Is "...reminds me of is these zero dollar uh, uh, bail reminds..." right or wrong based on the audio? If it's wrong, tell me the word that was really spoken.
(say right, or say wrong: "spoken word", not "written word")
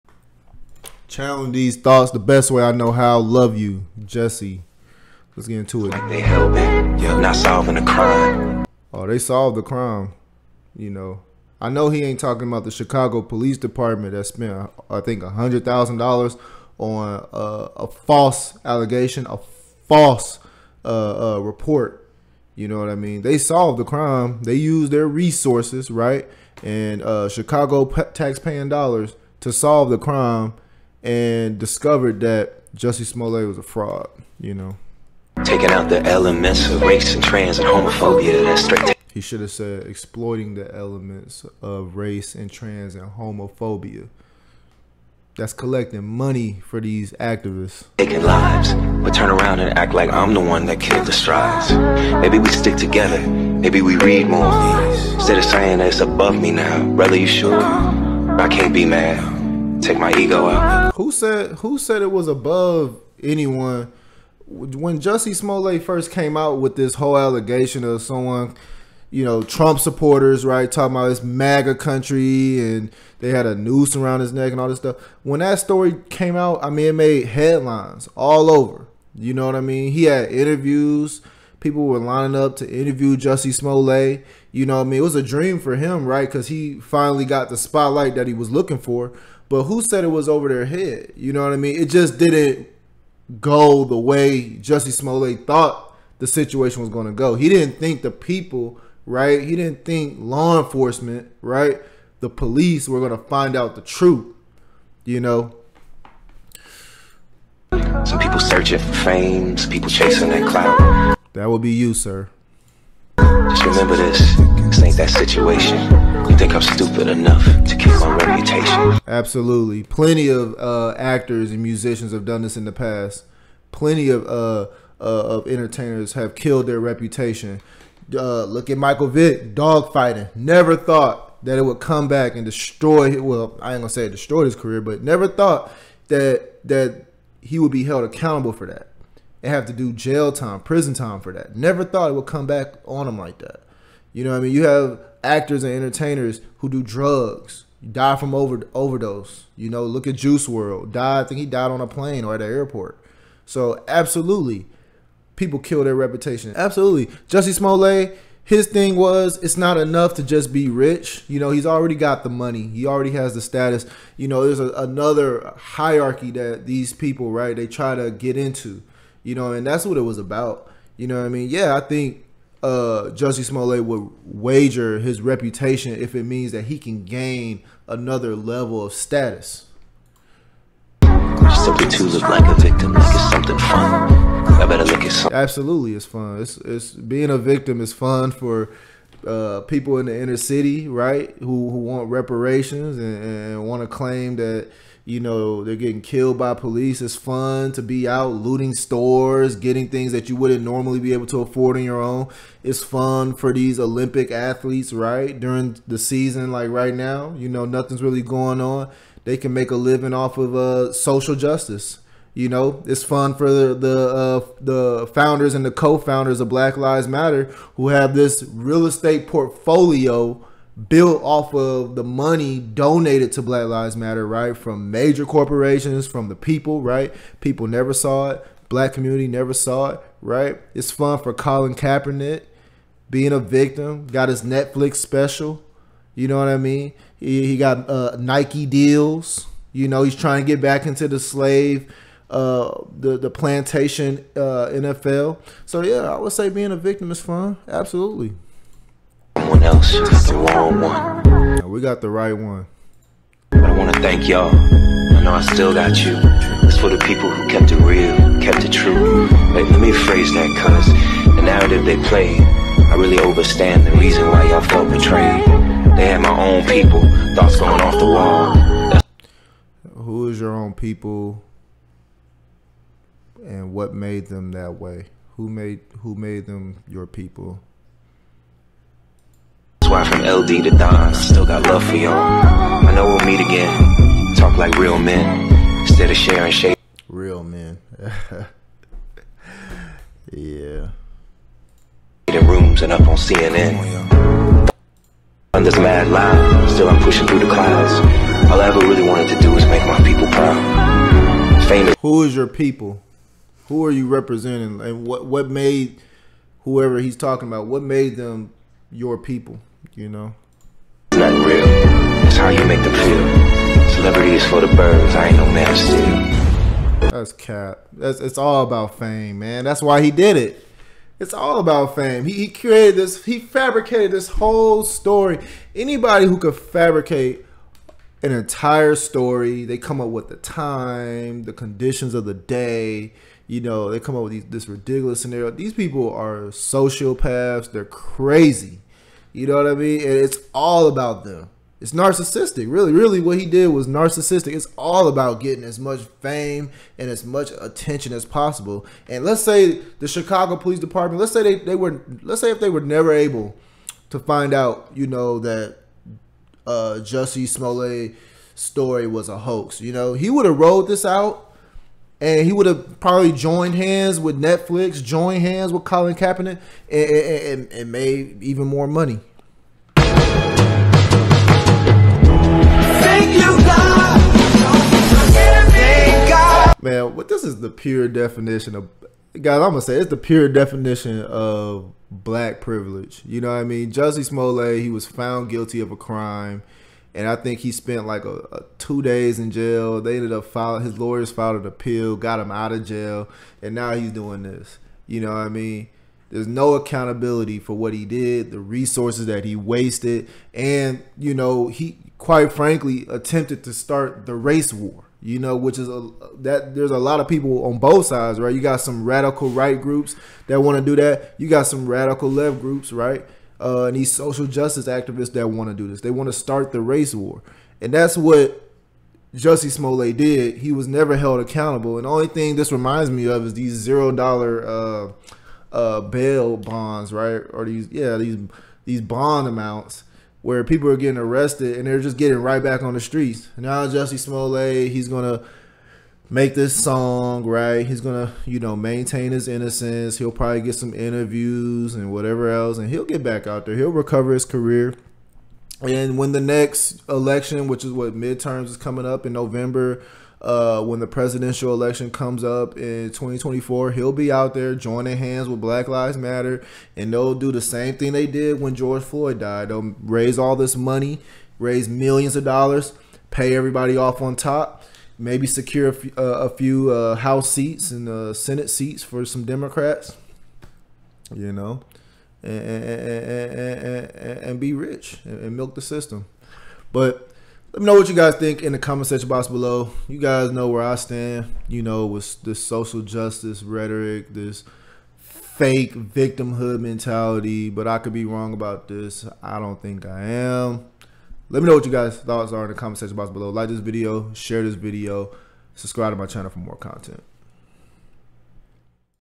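wrong: "bonds", not "reminds".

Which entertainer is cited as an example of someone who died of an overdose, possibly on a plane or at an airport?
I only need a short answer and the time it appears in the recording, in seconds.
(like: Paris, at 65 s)
Juice WRLD, at 150 s.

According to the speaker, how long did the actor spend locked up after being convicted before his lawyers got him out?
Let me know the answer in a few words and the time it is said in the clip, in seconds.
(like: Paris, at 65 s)
2 days, at 388 s.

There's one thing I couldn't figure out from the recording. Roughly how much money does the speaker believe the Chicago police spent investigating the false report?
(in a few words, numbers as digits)
$100,000.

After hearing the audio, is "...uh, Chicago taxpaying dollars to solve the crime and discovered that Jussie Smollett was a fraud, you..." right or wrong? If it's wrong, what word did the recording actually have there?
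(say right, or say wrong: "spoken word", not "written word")
right.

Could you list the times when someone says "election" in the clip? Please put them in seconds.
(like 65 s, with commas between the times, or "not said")
447 s, 451 s.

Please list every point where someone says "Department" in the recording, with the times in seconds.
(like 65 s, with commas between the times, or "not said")
13 s, 350 s.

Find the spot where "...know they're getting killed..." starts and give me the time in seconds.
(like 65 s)
195 s.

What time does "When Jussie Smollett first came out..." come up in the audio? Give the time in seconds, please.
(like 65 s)
64 s.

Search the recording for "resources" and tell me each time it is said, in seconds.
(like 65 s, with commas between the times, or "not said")
25 s, 398 s.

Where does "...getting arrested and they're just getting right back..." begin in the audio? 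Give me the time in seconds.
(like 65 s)
430 s.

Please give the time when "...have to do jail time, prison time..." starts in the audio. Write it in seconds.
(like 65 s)
139 s.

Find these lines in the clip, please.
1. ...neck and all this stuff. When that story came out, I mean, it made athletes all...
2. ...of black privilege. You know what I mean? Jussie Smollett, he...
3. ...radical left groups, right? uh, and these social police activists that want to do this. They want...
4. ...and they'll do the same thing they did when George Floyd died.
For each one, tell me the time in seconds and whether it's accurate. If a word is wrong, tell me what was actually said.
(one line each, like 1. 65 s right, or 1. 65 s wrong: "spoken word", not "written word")
1. 74 s wrong: "headlines", not "athletes"
2. 381 s right
3. 411 s wrong: "justice", not "police"
4. 456 s right.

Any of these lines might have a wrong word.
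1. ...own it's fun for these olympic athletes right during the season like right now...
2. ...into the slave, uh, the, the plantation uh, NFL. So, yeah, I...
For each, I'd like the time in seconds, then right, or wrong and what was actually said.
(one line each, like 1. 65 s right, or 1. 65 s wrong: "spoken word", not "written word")
1. 202 s right
2. 240 s right.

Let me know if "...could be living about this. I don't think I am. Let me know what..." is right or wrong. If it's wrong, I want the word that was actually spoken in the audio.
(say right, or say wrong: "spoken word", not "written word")
wrong: "wrong", not "living".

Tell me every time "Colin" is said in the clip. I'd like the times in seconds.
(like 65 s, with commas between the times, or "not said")
231 s, 365 s.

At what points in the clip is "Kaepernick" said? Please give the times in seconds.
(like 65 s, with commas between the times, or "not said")
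231 s, 366 s.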